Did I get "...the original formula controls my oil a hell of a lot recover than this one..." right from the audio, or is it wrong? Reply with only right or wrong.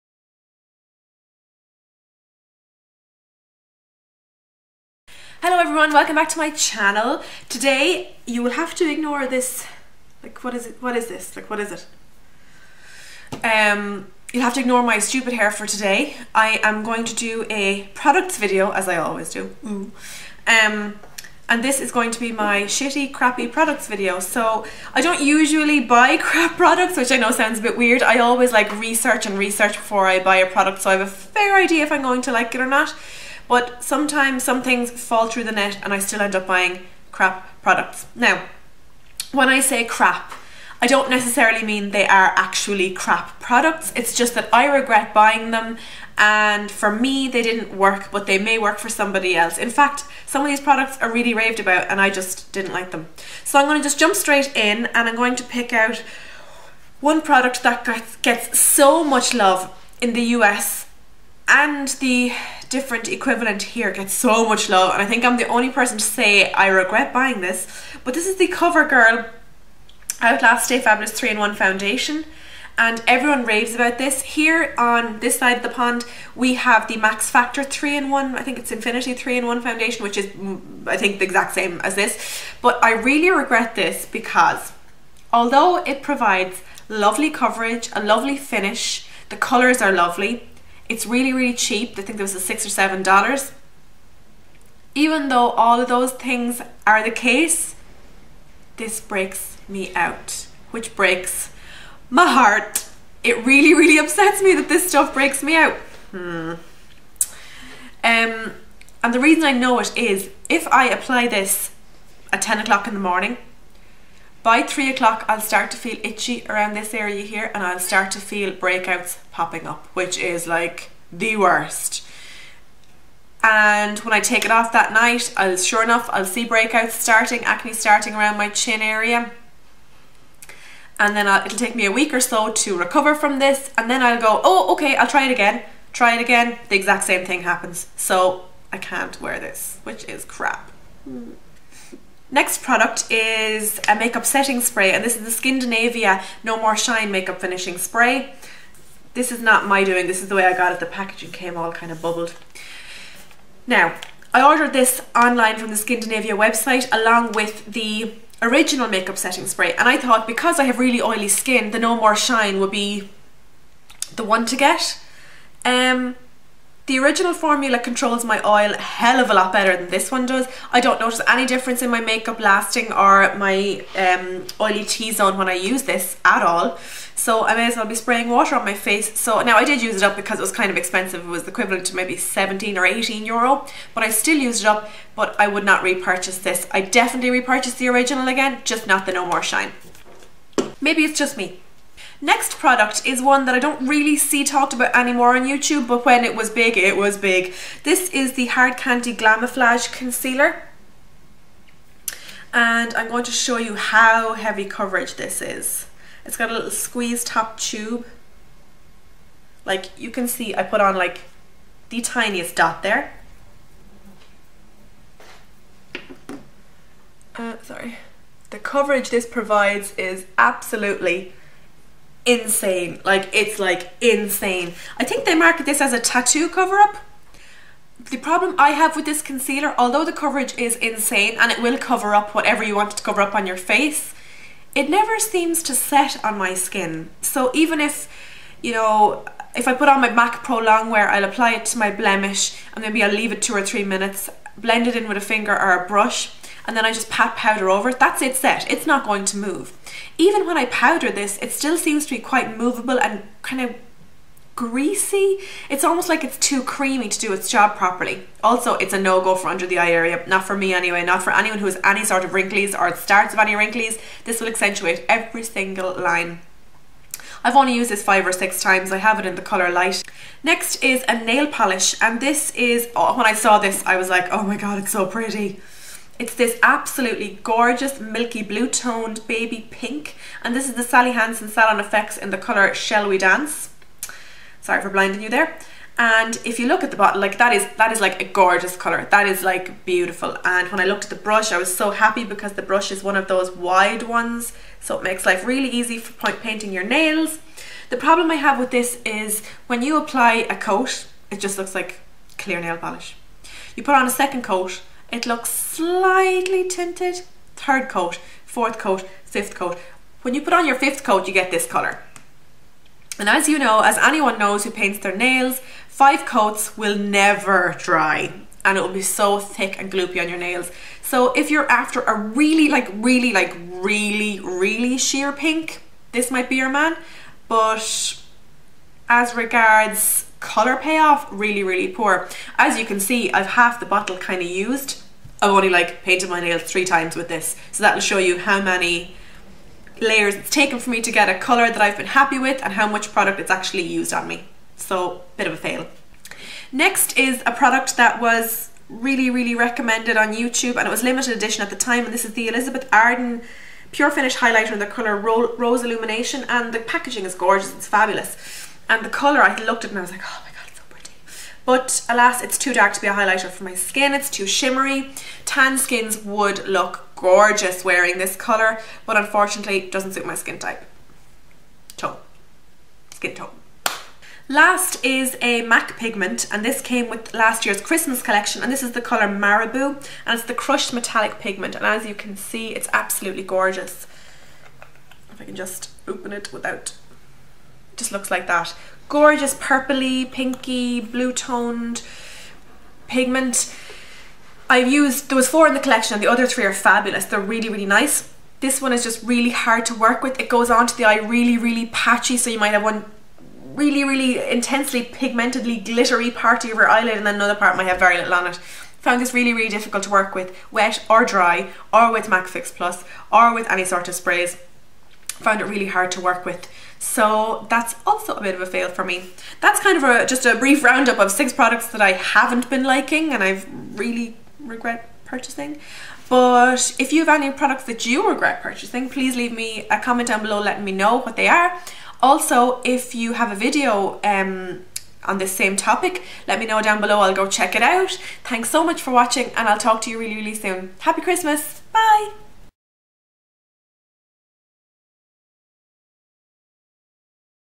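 wrong.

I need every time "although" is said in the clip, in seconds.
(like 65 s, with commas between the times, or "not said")
85 s, 229 s.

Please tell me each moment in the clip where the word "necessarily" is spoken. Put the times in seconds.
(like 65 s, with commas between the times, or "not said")
41 s.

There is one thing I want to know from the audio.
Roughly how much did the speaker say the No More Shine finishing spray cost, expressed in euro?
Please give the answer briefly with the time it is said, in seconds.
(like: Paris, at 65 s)
17 or 18 euro, at 182 s.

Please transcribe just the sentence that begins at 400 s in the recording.
It goes onto the eye really, really patchy.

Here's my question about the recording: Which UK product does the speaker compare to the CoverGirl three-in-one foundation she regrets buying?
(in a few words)
Max Factor 3-in-1.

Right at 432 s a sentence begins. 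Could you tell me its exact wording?
Also, if you have a video um, on this same topic, let me know down below.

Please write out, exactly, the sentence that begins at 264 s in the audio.
This will accentuate every single line.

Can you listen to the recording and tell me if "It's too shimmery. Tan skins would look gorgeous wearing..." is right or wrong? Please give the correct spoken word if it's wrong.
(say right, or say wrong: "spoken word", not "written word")
right.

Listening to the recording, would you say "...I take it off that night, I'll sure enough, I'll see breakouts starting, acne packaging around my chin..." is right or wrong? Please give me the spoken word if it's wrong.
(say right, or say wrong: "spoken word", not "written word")
wrong: "starting", not "packaging".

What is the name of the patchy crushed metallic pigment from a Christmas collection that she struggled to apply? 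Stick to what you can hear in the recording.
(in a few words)
Marabou.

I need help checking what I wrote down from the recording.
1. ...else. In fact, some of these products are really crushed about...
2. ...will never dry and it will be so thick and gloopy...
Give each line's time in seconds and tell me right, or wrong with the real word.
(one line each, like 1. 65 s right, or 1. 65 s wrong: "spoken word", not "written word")
1. 49 s wrong: "raved", not "crushed"
2. 316 s right.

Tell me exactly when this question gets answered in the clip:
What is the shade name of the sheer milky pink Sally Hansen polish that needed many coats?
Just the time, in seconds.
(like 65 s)
282 s.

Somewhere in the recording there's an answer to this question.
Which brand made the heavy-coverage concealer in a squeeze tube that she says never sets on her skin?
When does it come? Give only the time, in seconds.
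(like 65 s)
198 s.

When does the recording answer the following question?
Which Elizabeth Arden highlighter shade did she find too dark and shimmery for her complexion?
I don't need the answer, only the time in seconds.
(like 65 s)
355 s.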